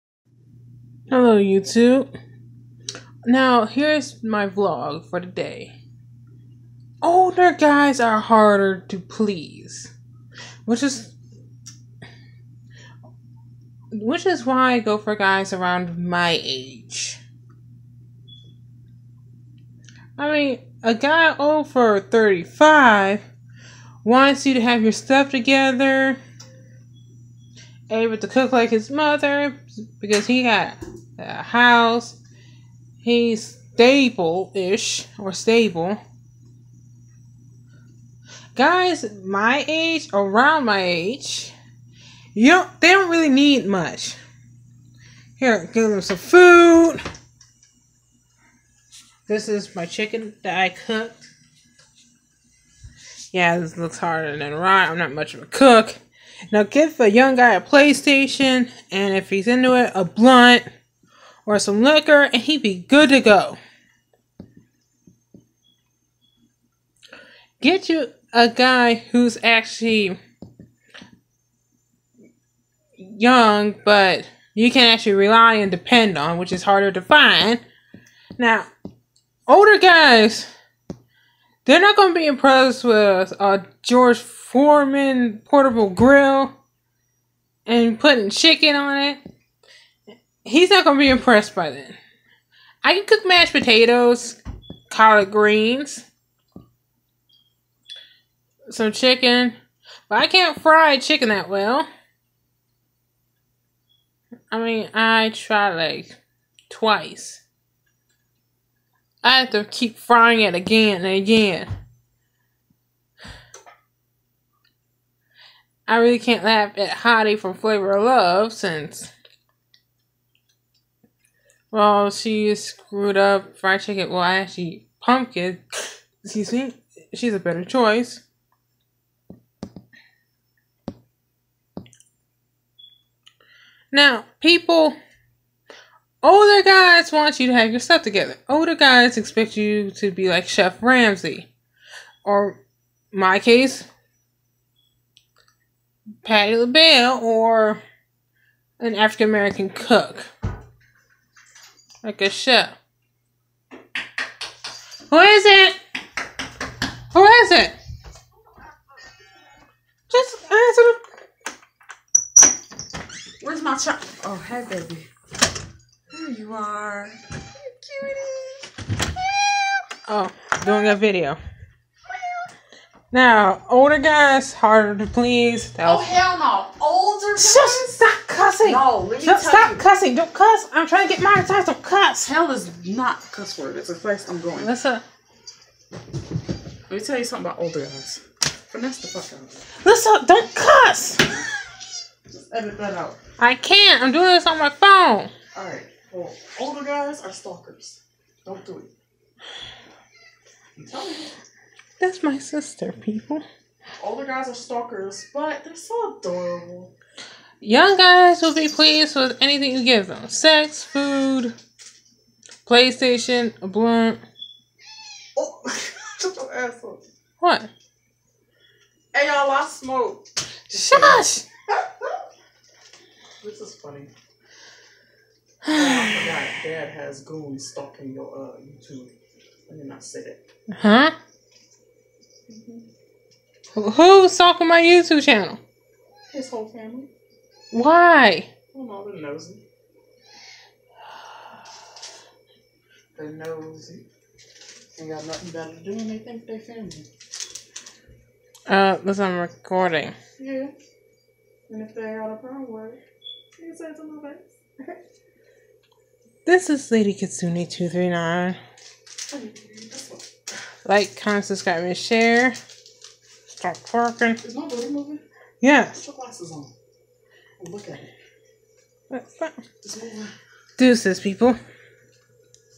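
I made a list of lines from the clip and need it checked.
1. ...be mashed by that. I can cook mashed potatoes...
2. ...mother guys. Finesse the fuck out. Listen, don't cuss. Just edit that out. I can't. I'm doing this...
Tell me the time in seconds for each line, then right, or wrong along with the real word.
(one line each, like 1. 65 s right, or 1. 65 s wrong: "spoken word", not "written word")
1. 91 s wrong: "impressed", not "mashed"
2. 187 s wrong: "older", not "mother".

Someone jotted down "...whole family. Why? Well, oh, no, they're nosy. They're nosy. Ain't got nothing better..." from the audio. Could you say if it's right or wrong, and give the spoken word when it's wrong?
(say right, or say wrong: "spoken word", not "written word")
right.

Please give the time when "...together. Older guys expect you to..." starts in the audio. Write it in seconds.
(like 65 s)
138 s.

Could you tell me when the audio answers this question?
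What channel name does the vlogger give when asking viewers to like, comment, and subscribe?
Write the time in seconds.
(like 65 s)
256 s.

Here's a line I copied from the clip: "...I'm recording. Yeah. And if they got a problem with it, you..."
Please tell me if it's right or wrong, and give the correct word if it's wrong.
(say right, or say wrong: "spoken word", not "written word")
right.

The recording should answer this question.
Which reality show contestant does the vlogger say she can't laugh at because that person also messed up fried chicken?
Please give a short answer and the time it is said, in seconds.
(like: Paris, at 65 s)
Hottie, at 116 s.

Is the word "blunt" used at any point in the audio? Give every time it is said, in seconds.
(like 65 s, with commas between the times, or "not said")
60 s, 213 s.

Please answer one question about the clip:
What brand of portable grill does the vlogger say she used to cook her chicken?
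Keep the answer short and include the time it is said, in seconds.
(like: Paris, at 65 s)
George Foreman, at 83 s.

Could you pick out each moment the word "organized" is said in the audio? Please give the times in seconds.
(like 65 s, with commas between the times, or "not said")
not said.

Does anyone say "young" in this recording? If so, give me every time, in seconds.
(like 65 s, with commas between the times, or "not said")
57 s, 72 s, 207 s.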